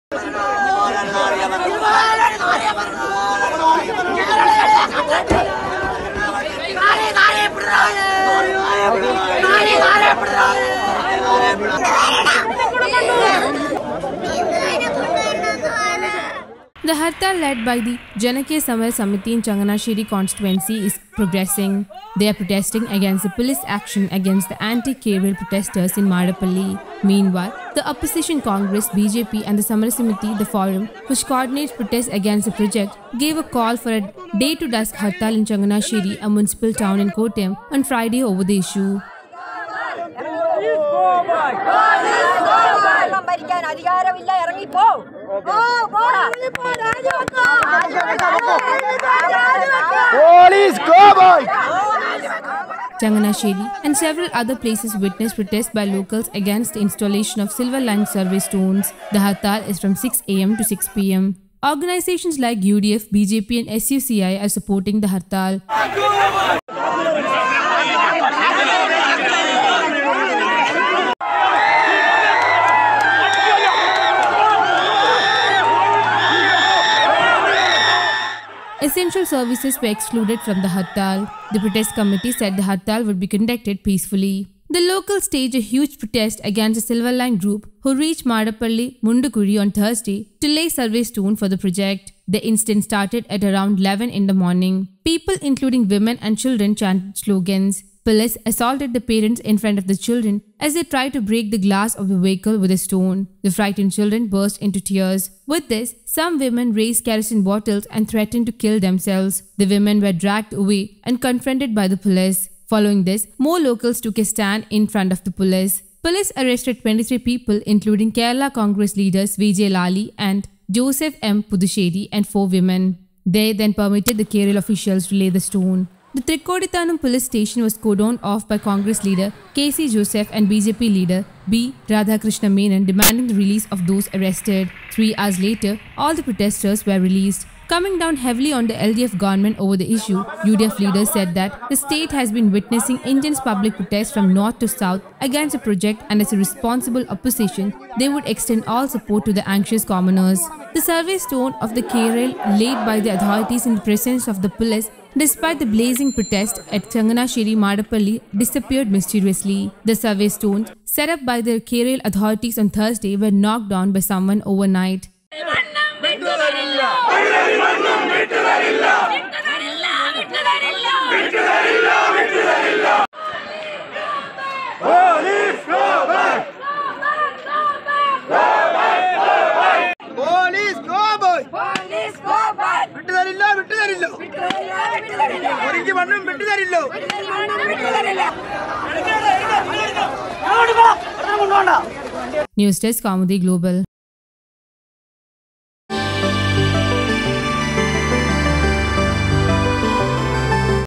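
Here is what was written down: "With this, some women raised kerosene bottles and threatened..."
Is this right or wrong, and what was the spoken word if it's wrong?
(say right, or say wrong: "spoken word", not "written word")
right.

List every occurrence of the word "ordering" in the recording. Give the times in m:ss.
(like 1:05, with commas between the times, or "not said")
not said.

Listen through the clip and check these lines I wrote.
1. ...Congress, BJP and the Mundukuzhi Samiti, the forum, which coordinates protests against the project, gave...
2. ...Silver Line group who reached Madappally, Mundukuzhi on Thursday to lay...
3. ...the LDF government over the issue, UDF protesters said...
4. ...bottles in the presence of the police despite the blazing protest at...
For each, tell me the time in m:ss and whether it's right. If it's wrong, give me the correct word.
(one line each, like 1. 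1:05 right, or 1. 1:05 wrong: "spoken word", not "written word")
1. 0:28 wrong: "Samar", not "Mundukuzhi"
2. 1:26 right
3. 2:18 wrong: "leaders", not "protesters"
4. 2:33 wrong: "authorities", not "bottles".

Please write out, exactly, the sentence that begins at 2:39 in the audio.
The survey stones set up by the K-rail authorities on Thursday were knocked down by someone overnight.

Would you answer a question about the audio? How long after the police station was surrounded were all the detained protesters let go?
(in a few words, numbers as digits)
Three hours.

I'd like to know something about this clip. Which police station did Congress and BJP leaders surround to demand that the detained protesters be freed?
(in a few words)
Thrikkodithanam.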